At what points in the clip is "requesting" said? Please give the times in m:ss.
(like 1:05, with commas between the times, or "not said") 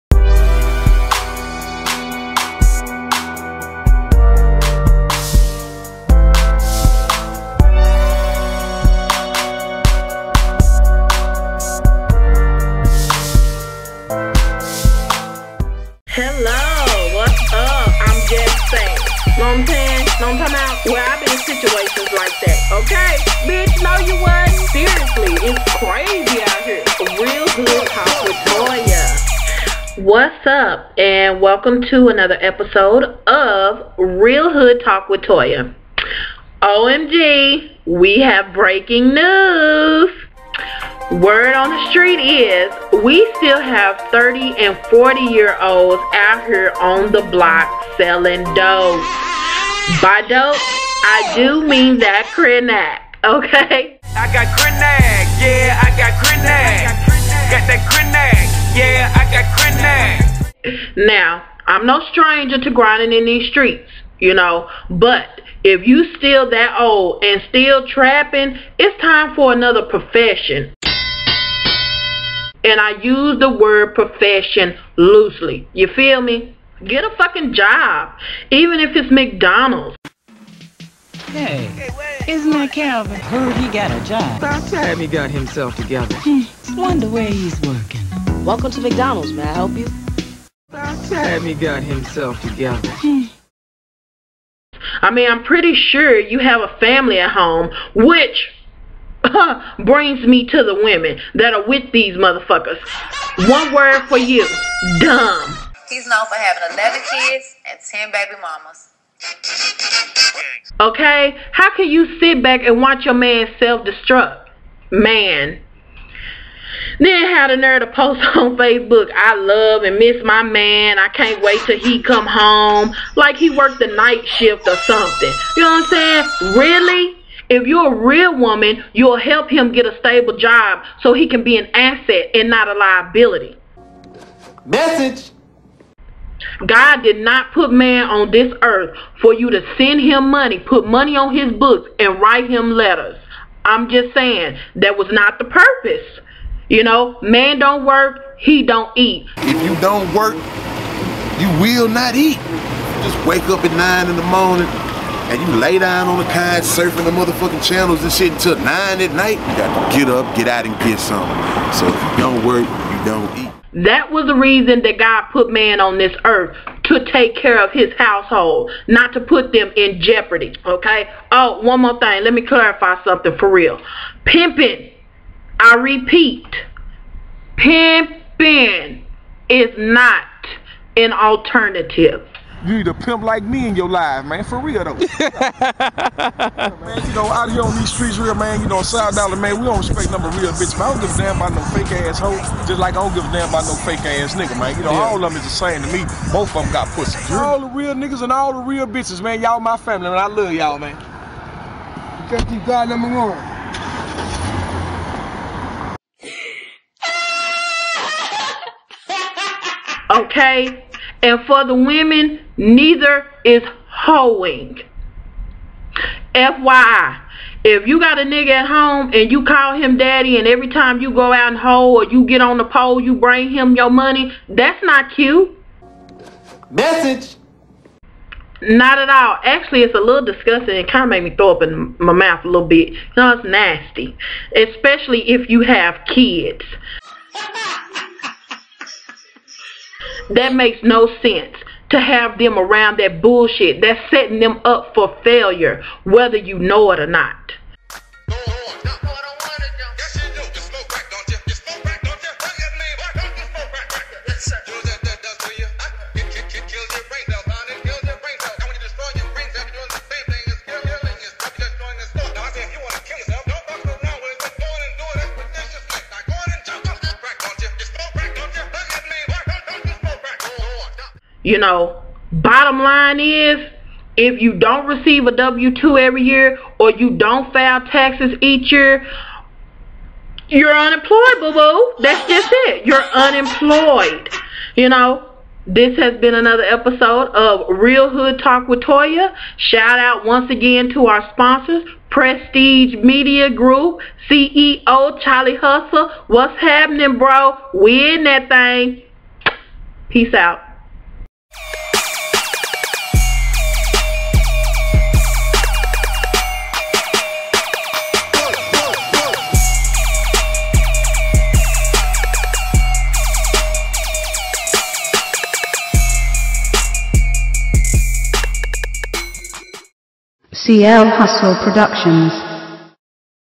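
not said.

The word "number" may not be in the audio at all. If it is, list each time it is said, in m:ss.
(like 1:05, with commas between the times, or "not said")
3:10, 3:22.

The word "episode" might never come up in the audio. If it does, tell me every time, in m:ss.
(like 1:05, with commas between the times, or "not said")
0:32, 4:46.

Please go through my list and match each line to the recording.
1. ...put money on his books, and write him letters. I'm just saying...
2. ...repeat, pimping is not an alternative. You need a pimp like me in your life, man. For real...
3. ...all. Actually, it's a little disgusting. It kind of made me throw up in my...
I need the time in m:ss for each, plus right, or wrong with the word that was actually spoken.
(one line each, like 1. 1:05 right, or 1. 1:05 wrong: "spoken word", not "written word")
1. 2:20 right
2. 2:55 right
3. 3:49 right.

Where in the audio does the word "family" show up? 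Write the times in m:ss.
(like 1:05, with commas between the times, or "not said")
1:36, 3:19.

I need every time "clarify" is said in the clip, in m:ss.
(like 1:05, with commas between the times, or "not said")
2:52.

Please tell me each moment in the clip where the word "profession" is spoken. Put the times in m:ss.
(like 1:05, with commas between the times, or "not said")
1:09, 1:13.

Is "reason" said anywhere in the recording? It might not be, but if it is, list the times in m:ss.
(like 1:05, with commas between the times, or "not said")
2:44.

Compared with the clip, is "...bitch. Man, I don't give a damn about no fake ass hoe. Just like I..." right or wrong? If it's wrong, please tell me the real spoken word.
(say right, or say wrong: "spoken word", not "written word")
right.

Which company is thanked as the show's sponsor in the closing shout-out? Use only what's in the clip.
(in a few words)
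Prestige Media Group.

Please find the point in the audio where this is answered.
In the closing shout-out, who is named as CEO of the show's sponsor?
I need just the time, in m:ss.
4:55.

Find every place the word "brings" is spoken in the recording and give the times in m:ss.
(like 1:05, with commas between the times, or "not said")
1:39, 3:43.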